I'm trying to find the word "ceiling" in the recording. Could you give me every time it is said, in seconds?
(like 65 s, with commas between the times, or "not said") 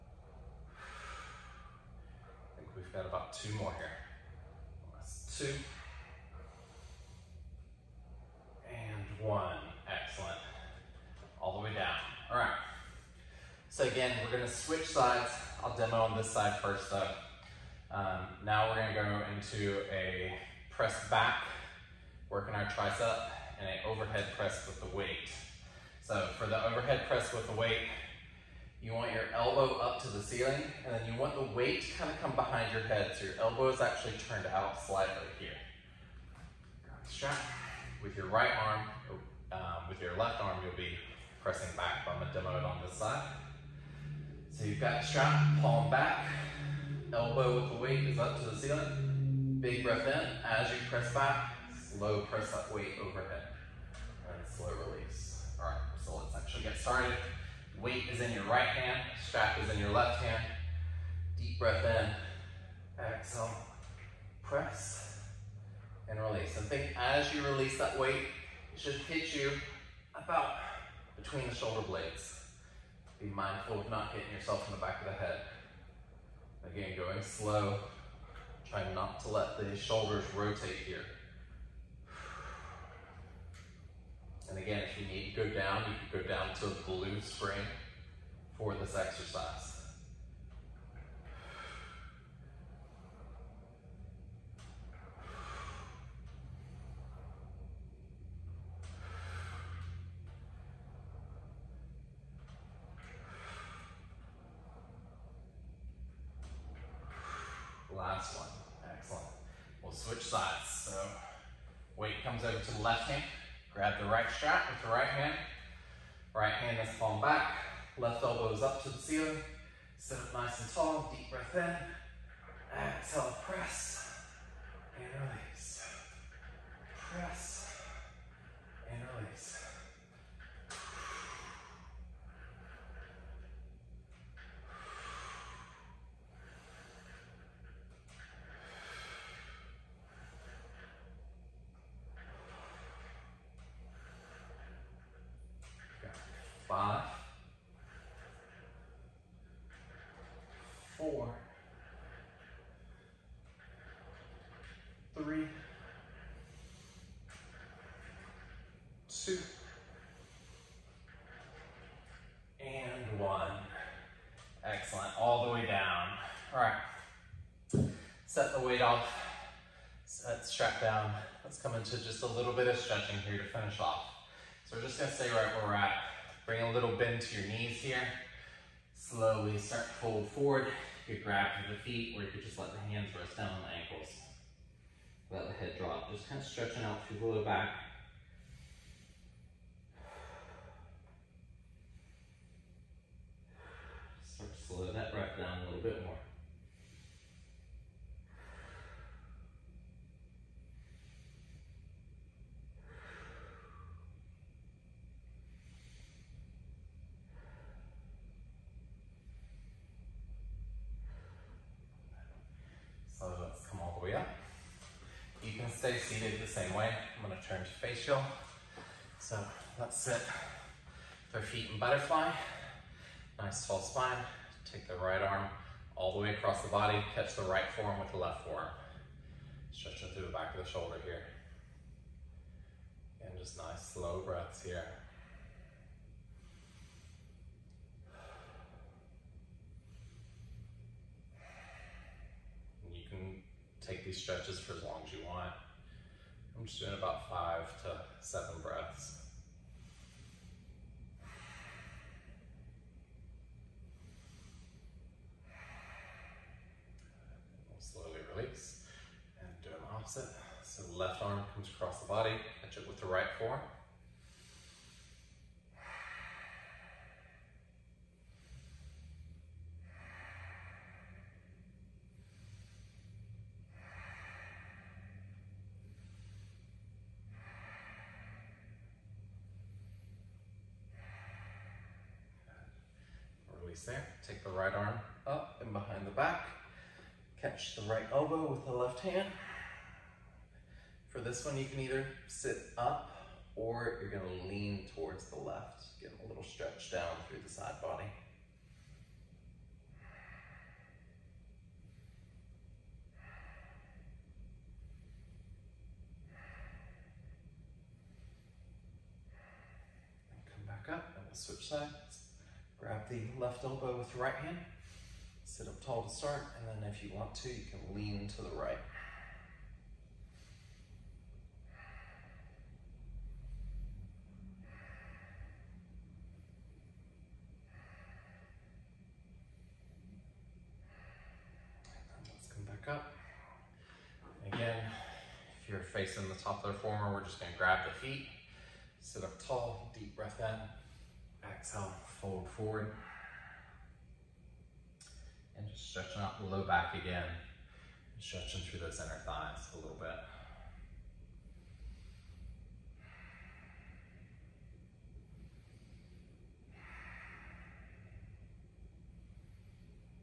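30 s, 48 s, 118 s.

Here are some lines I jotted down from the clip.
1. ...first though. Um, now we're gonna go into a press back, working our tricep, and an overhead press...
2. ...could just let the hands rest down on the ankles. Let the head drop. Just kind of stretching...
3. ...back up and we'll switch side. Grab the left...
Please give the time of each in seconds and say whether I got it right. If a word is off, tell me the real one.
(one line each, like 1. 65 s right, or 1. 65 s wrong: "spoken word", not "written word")
1. 16 s right
2. 182 s right
3. 310 s right.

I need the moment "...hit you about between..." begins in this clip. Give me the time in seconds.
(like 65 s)
68 s.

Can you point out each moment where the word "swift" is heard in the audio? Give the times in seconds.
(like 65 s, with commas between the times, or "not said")
not said.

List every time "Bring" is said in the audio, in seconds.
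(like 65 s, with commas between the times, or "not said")
176 s.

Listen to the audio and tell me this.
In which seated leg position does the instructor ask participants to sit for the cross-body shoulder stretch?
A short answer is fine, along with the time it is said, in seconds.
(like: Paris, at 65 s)
Butterfly, at 221 s.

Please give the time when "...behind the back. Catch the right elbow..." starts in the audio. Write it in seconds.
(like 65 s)
285 s.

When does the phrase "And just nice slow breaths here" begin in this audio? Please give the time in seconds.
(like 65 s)
233 s.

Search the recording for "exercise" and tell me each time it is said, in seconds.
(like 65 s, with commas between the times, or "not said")
88 s.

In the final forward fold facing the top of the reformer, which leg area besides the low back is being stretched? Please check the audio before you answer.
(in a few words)
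Inner thighs.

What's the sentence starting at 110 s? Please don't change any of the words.
So weight comes over to the left hand.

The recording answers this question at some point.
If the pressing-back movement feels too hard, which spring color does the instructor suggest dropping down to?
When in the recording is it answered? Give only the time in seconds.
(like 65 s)
86 s.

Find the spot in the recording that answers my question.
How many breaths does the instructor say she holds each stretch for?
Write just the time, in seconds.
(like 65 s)
247 s.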